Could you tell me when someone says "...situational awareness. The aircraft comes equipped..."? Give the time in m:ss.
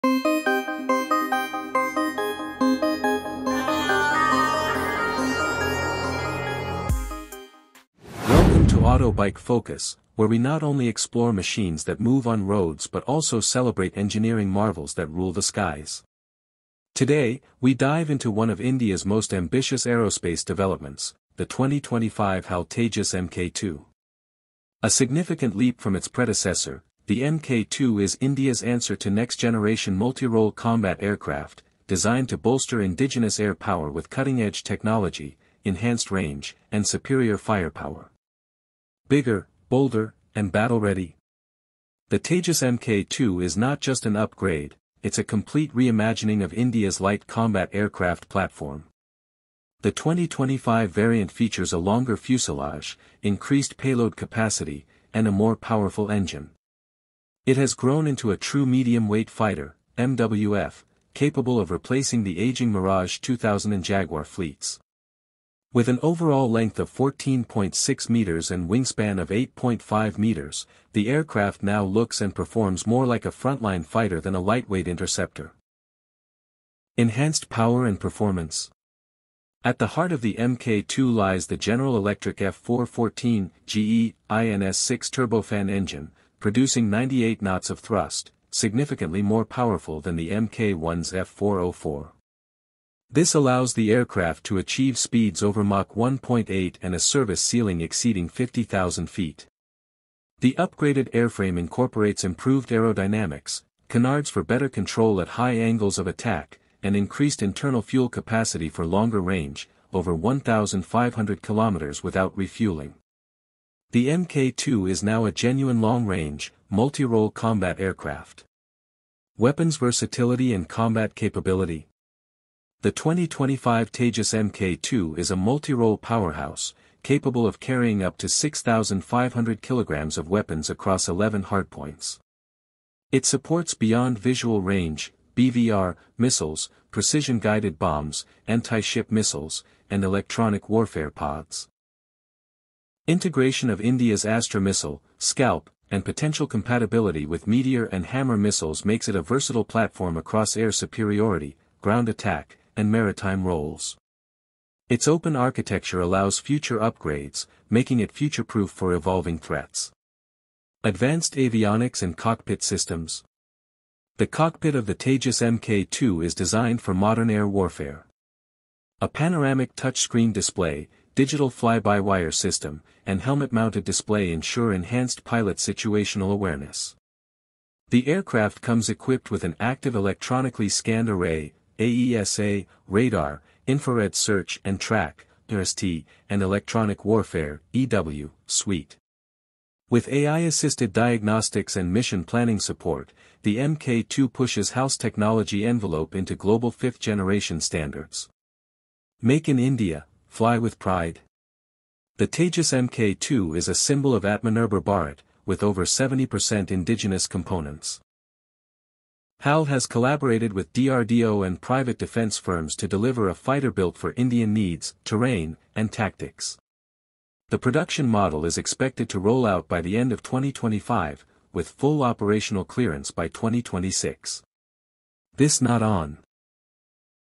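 2:55.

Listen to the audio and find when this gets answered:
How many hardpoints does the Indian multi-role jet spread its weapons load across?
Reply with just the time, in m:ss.
2:11.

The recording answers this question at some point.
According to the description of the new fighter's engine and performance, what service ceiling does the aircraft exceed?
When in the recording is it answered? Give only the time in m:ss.
1:38.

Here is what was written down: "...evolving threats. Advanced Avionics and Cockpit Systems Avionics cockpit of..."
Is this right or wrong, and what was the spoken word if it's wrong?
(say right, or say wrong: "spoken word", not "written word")
wrong: "The", not "Avionics".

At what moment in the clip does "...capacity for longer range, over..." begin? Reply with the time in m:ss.
1:48.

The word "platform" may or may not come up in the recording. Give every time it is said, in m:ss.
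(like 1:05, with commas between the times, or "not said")
0:48, 2:29.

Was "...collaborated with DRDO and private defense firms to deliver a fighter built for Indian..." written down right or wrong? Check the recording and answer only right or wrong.
right.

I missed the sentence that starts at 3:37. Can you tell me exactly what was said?
The production model is expected to roll out by the end of 2025, with full operational clearance by 2026.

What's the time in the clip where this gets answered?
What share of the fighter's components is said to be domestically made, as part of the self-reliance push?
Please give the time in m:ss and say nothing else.
3:25.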